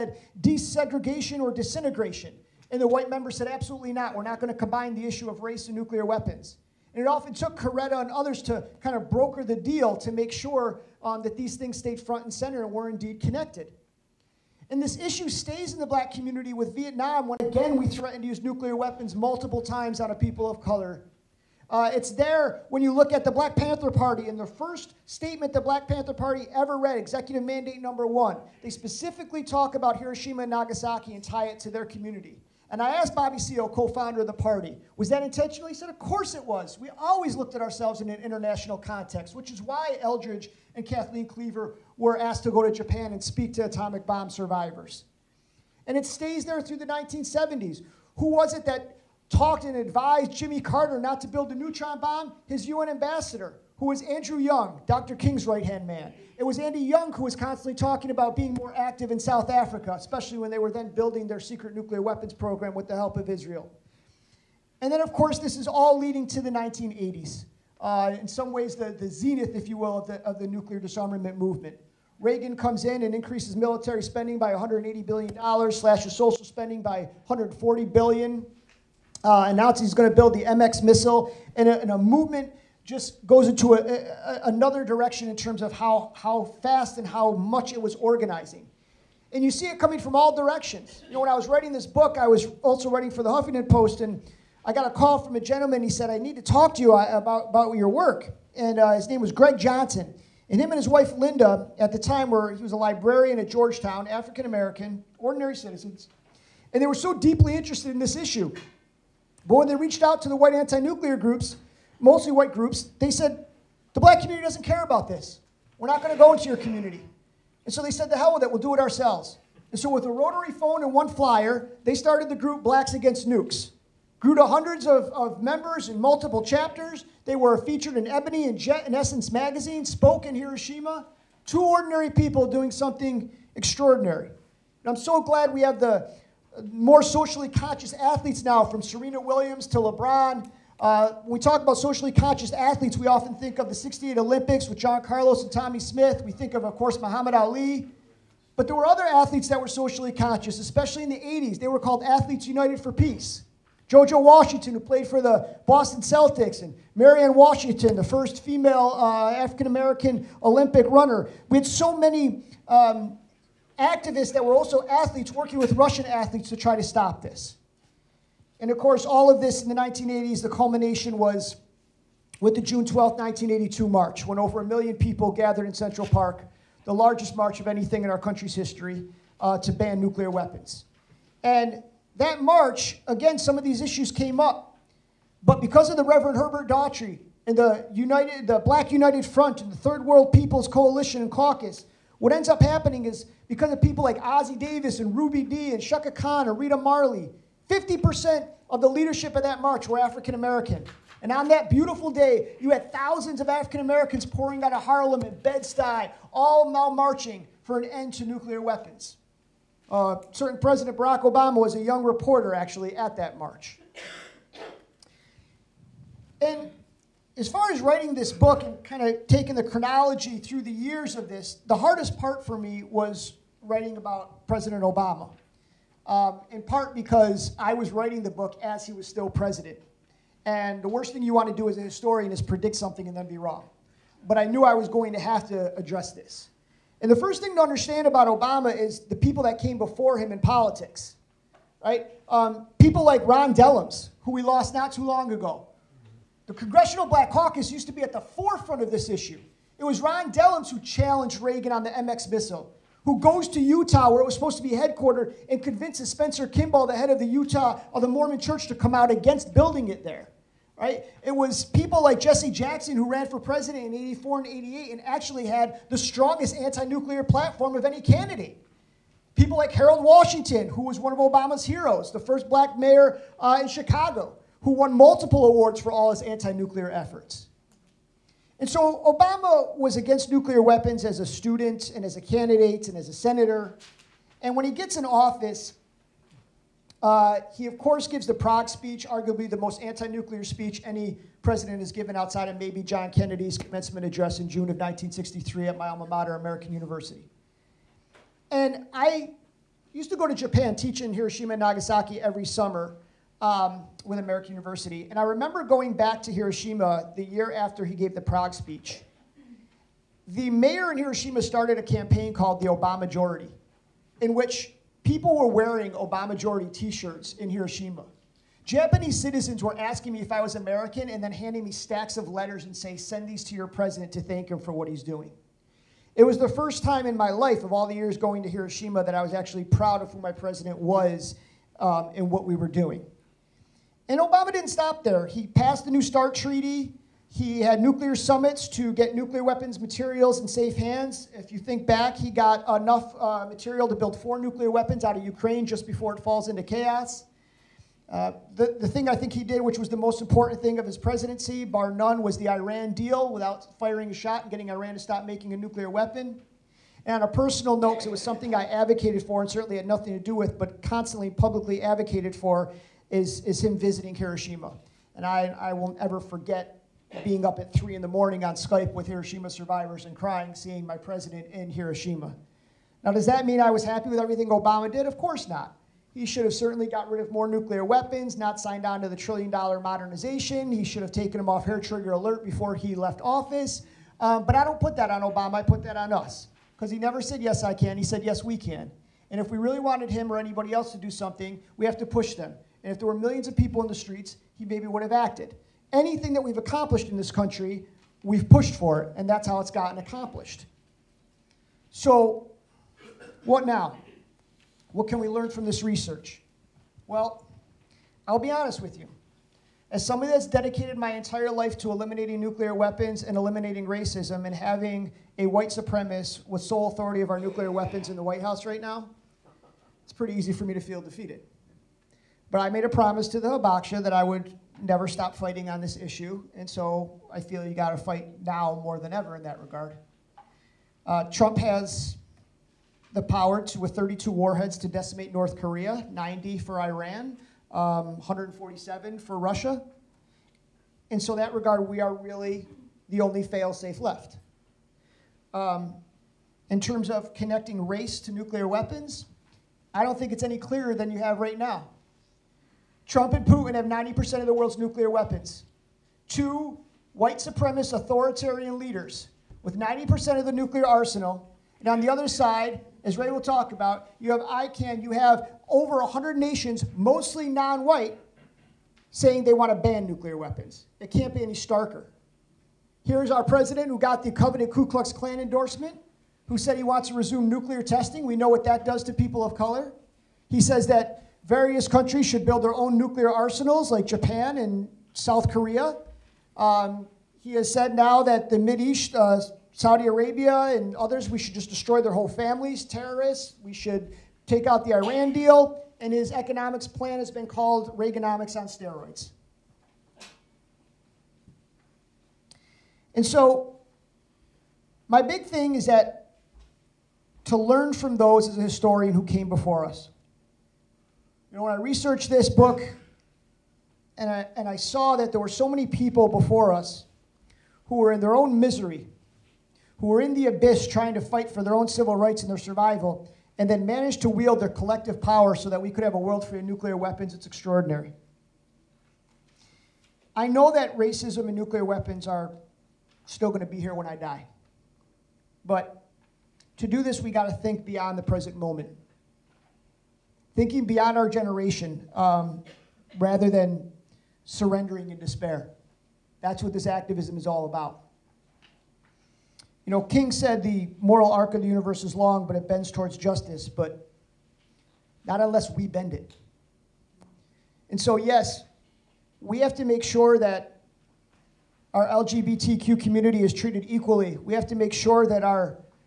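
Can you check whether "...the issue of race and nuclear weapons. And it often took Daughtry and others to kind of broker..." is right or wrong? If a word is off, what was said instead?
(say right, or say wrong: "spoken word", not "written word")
wrong: "Coretta", not "Daughtry".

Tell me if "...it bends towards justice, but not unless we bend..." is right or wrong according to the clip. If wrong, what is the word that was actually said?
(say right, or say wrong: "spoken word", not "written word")
right.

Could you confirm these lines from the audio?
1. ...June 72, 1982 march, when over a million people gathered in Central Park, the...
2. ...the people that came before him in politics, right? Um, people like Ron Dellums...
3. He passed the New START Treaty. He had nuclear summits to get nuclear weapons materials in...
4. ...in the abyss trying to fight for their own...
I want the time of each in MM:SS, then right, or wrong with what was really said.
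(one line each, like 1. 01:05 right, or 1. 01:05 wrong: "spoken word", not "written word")
1. 02:52 wrong: "12", not "72"
2. 03:59 right
3. 05:35 right
4. 08:40 right.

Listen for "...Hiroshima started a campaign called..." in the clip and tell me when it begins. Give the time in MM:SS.
05:10.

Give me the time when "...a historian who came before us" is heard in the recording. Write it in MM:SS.
08:28.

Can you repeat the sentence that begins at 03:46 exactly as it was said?
Um, in part because I was writing the book as he was still president.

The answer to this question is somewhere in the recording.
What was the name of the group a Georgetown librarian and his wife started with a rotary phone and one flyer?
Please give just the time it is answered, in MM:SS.
02:02.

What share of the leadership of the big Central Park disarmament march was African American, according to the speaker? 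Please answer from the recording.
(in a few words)
50%.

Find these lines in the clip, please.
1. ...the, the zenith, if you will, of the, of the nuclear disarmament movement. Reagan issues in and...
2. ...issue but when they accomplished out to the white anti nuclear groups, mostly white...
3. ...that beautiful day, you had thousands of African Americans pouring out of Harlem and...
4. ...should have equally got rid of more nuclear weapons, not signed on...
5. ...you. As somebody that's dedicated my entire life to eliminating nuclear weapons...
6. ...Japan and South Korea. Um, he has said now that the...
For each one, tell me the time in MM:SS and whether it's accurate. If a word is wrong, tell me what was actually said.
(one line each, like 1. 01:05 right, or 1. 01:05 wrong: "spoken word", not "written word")
1. 01:08 wrong: "comes", not "issues"
2. 01:48 wrong: "reached", not "accomplished"
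3. 03:21 right
4. 06:16 wrong: "certainly", not "equally"
5. 06:48 right
6. 08:04 right.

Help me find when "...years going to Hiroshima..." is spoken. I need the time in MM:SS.
05:27.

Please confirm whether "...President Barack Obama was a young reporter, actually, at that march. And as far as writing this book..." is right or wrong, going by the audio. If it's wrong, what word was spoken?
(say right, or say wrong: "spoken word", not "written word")
right.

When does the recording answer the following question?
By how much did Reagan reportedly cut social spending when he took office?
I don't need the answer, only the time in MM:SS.
01:17.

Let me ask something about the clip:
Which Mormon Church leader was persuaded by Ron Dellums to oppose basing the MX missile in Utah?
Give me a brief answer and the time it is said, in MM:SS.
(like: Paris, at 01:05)
Spencer Kimball, at 04:16.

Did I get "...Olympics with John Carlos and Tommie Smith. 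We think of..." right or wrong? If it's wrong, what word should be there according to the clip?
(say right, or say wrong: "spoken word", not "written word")
right.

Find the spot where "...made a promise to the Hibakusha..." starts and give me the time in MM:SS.
07:02.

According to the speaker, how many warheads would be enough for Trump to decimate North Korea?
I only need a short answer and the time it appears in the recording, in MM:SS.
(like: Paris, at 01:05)
32, at 07:13.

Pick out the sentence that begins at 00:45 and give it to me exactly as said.
And it stays there through the 1970s.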